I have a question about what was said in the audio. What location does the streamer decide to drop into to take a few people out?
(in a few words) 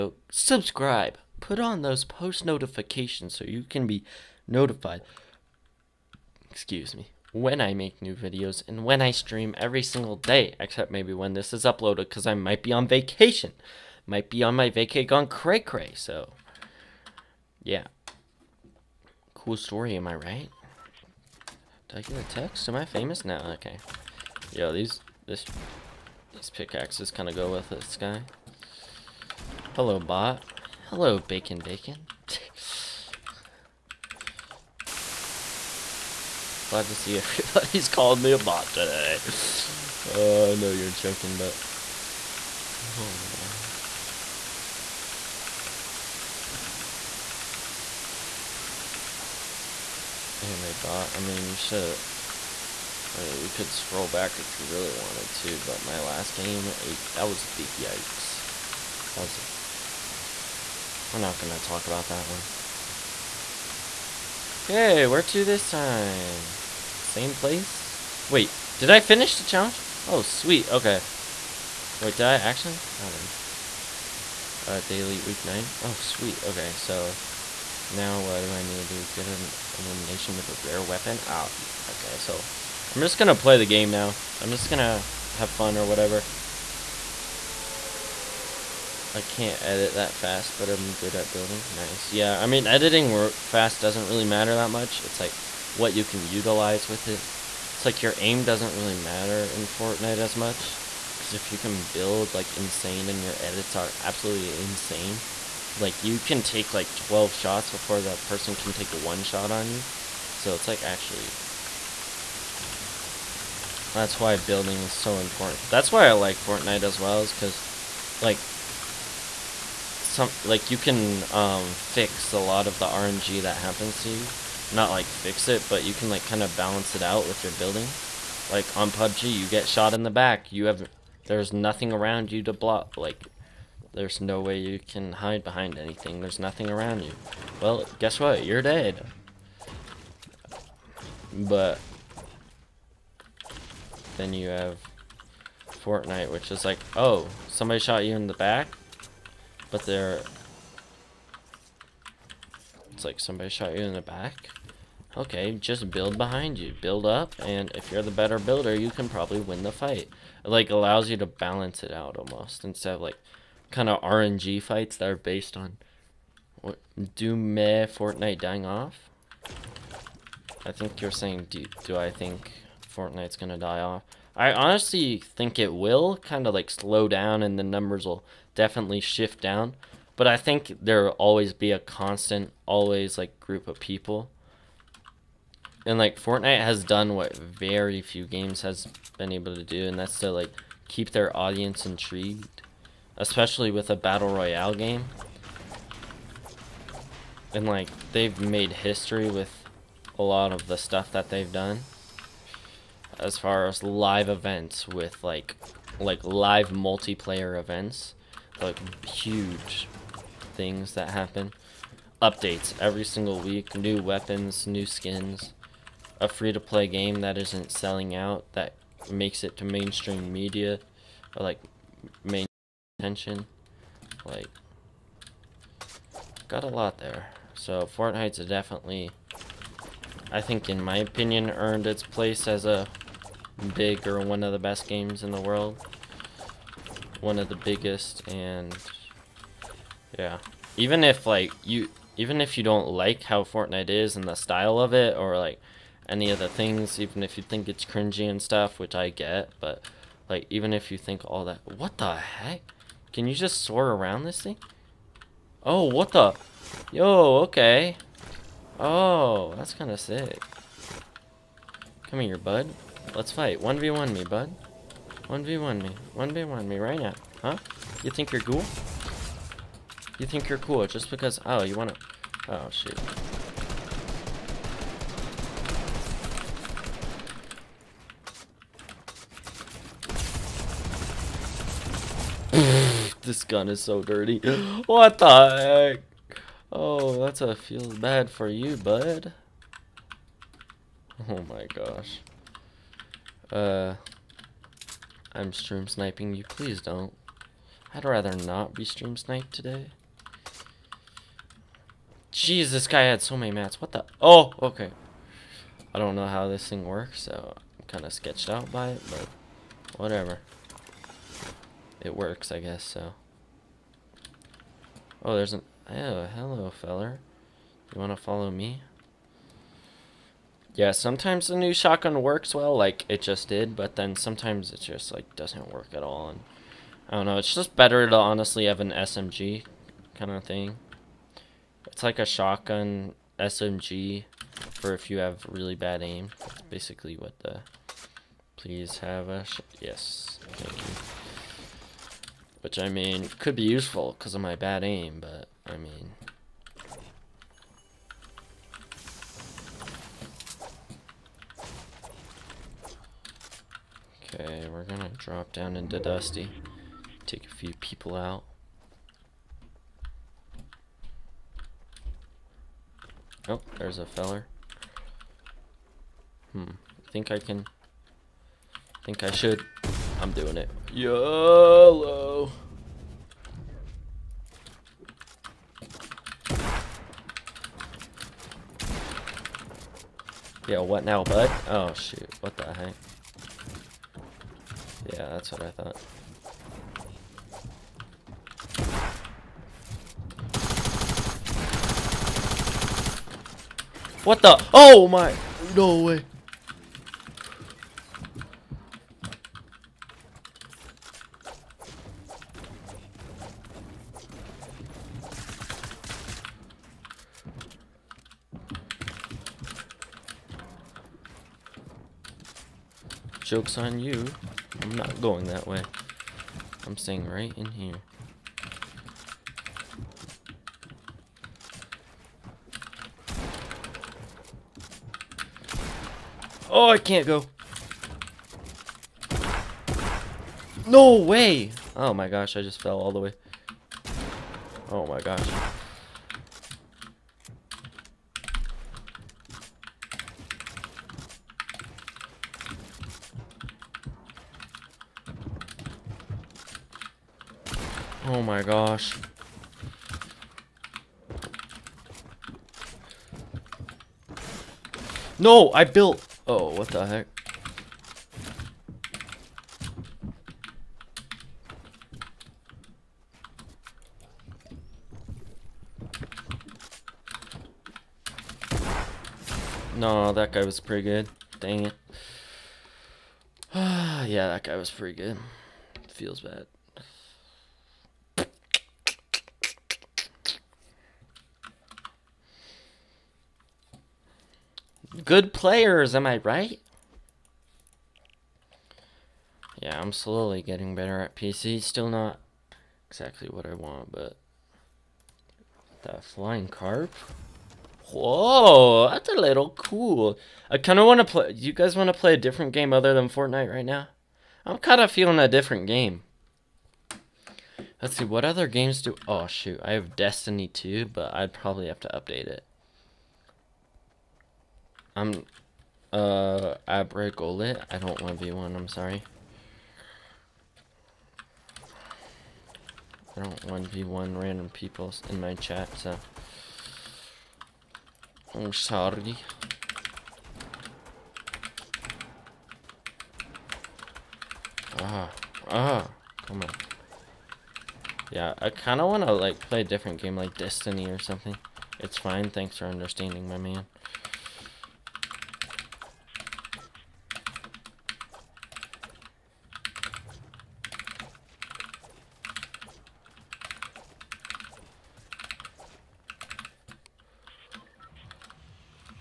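Dusty.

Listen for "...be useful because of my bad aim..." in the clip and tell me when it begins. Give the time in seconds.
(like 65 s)
343 s.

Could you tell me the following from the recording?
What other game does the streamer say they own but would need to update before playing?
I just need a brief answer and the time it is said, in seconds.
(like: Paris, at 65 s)
Destiny 2, at 510 s.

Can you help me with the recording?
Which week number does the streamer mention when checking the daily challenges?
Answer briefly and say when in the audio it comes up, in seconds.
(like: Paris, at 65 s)
Week 9, at 75 s.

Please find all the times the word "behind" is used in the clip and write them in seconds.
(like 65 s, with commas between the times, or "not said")
135 s, 156 s.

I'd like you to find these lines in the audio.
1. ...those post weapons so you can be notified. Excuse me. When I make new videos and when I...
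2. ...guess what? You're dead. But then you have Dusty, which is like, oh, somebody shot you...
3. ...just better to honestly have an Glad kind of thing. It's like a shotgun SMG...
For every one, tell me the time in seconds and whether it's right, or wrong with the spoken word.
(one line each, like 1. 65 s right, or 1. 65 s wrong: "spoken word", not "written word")
1. 1 s wrong: "notifications", not "weapons"
2. 137 s wrong: "Fortnite", not "Dusty"
3. 327 s wrong: "SMG", not "Glad".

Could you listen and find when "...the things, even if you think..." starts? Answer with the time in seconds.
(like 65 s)
246 s.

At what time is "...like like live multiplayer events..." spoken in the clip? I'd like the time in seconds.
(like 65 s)
205 s.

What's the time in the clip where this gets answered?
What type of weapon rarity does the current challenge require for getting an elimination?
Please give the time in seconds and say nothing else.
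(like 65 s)
80 s.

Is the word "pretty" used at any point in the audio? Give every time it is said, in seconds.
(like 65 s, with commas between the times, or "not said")
470 s, 474 s.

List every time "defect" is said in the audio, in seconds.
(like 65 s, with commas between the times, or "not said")
not said.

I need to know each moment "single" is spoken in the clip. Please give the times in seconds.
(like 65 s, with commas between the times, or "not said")
9 s, 213 s.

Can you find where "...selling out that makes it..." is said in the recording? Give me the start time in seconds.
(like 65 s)
217 s.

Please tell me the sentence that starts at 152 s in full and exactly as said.
It's like somebody shot you in the back.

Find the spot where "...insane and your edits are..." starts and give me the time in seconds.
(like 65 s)
102 s.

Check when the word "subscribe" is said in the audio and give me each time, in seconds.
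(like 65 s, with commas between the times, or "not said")
0 s.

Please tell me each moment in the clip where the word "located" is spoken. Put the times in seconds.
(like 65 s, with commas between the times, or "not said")
not said.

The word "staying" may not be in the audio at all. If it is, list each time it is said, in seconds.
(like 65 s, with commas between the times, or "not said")
416 s.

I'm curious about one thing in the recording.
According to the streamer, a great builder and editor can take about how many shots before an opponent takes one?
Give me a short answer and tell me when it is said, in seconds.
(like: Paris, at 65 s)
12, at 106 s.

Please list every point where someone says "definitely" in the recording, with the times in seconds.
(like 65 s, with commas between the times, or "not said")
178 s, 228 s.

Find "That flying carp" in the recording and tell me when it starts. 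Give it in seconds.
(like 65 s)
496 s.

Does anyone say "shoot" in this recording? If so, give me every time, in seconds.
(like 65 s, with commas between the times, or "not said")
272 s, 381 s, 509 s.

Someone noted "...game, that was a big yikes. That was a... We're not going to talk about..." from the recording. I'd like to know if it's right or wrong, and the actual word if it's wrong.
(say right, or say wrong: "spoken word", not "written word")
right.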